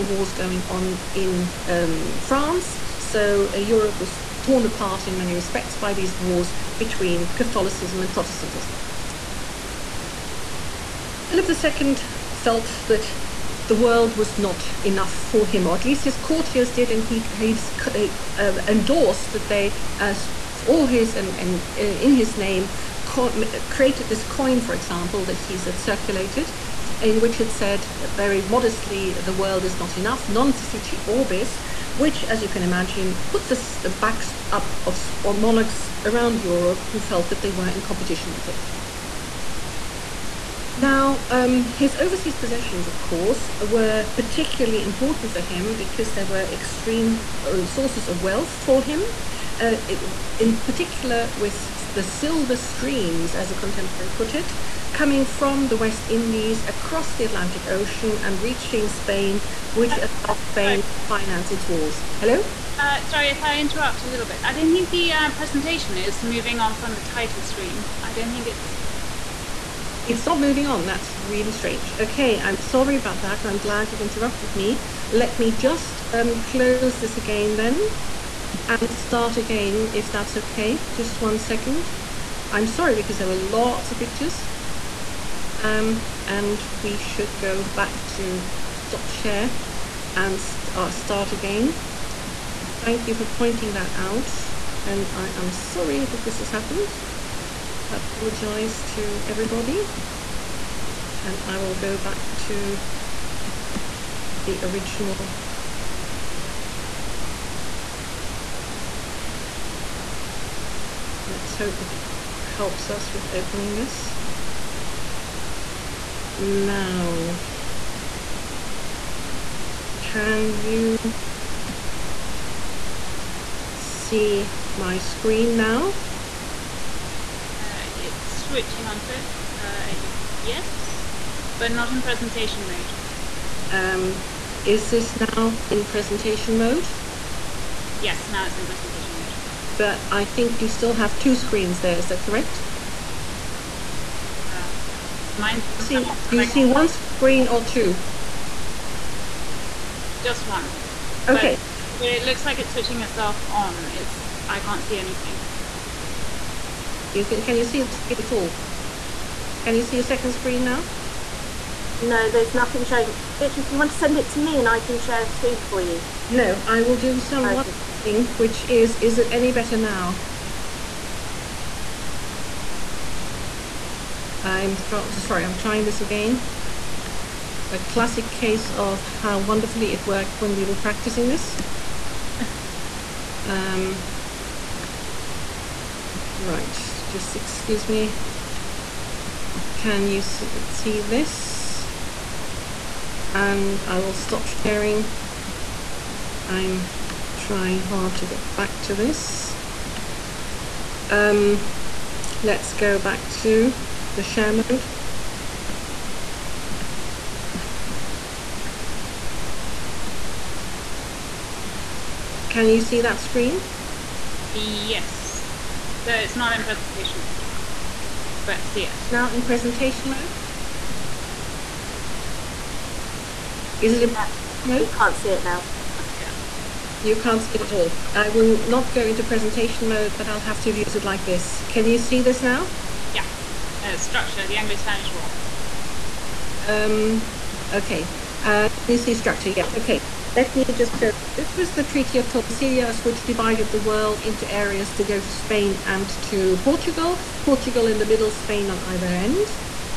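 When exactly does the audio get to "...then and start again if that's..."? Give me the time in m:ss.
1:17.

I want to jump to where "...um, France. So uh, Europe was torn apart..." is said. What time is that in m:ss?
0:01.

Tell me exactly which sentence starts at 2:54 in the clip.
I'm sorry, I'm trying this again.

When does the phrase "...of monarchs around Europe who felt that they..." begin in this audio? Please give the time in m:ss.
0:34.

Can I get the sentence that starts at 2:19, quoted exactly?
But I think you still have two screens there, is that correct?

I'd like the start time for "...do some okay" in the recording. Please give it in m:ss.
2:46.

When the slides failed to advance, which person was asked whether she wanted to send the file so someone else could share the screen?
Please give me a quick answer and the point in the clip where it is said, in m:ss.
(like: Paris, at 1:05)
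Beatrice, at 2:43.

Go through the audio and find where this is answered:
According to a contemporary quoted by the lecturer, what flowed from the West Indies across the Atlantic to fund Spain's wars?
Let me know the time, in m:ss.
0:52.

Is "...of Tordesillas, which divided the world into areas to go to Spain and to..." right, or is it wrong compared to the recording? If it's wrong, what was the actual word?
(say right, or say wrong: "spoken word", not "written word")
right.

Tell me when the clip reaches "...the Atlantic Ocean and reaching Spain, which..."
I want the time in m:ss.
0:57.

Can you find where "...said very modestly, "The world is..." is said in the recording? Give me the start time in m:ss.
0:27.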